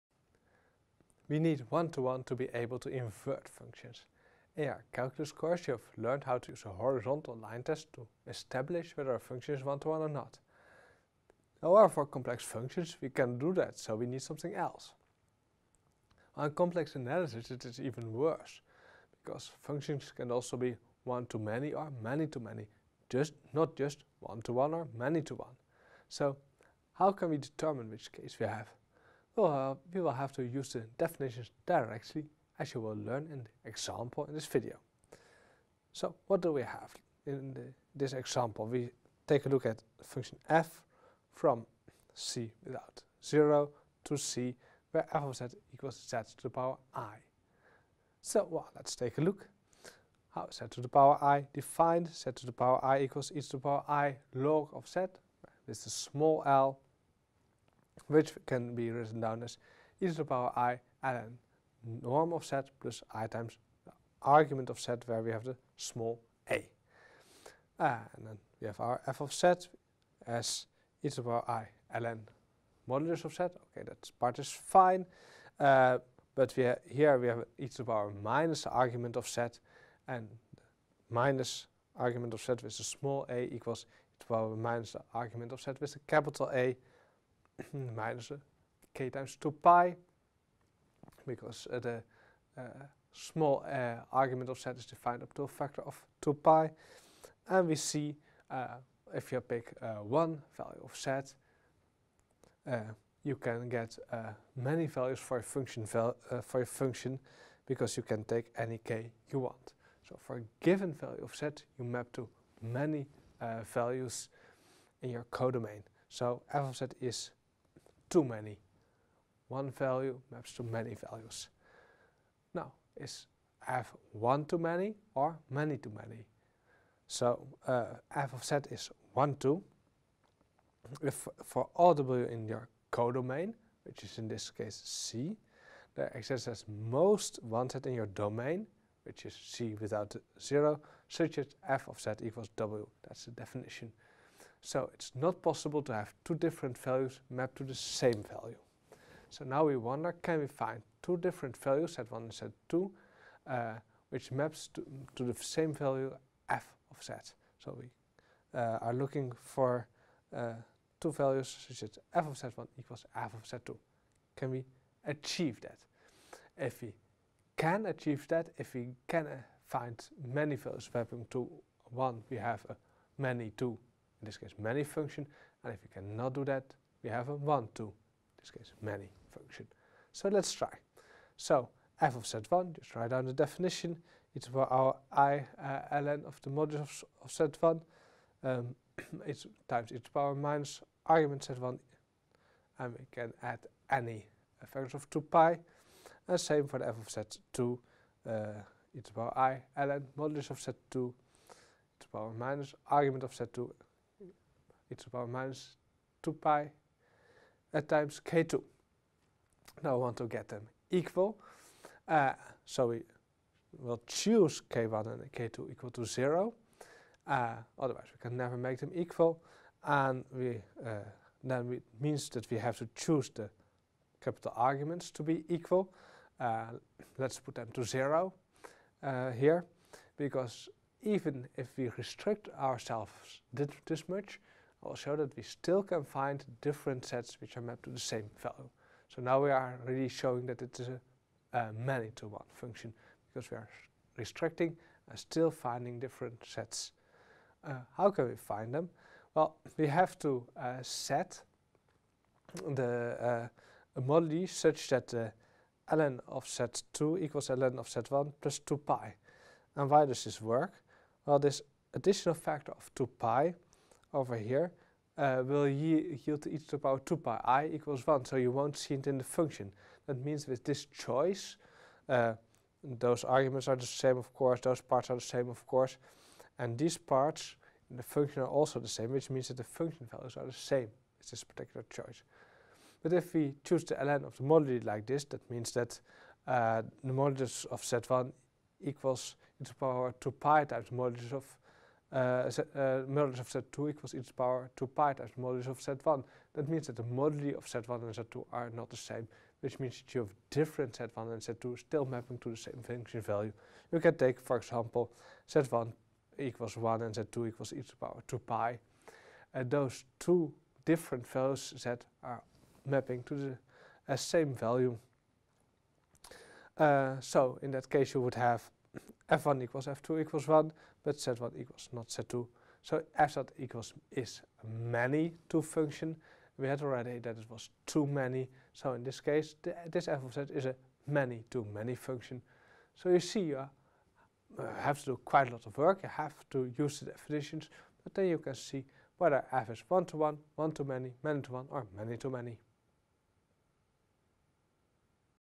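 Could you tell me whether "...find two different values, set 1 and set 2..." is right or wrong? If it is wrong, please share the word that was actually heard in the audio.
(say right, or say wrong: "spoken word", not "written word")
right.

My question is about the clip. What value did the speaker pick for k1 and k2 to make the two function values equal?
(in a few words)
0.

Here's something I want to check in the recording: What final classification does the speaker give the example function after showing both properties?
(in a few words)
many-to-many.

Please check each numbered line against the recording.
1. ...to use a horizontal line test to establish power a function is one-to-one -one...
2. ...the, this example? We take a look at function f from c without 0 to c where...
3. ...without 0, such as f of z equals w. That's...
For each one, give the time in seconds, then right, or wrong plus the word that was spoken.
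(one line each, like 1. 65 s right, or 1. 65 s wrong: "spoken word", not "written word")
1. 6 s wrong: "whether", not "power"
2. 37 s right
3. 139 s right.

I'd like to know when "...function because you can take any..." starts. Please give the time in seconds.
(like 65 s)
106 s.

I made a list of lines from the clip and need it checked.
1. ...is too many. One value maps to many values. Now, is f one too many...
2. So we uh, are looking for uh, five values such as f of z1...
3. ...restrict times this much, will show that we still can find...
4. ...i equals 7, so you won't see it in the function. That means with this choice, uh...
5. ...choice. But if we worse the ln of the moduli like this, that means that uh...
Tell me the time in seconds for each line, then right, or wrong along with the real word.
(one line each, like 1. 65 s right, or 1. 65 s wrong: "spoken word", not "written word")
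1. 116 s right
2. 157 s wrong: "two", not "five"
3. 231 s wrong: "ourselves", not "times"
4. 267 s wrong: "1", not "7"
5. 281 s wrong: "choose", not "worse".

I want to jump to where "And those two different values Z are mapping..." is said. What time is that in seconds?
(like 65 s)
309 s.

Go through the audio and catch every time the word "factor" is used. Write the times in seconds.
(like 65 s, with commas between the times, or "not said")
95 s, 262 s.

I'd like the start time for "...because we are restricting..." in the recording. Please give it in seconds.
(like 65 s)
243 s.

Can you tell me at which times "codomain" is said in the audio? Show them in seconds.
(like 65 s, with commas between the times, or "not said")
115 s, 132 s.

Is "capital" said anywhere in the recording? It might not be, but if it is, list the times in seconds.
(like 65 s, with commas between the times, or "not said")
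86 s, 224 s.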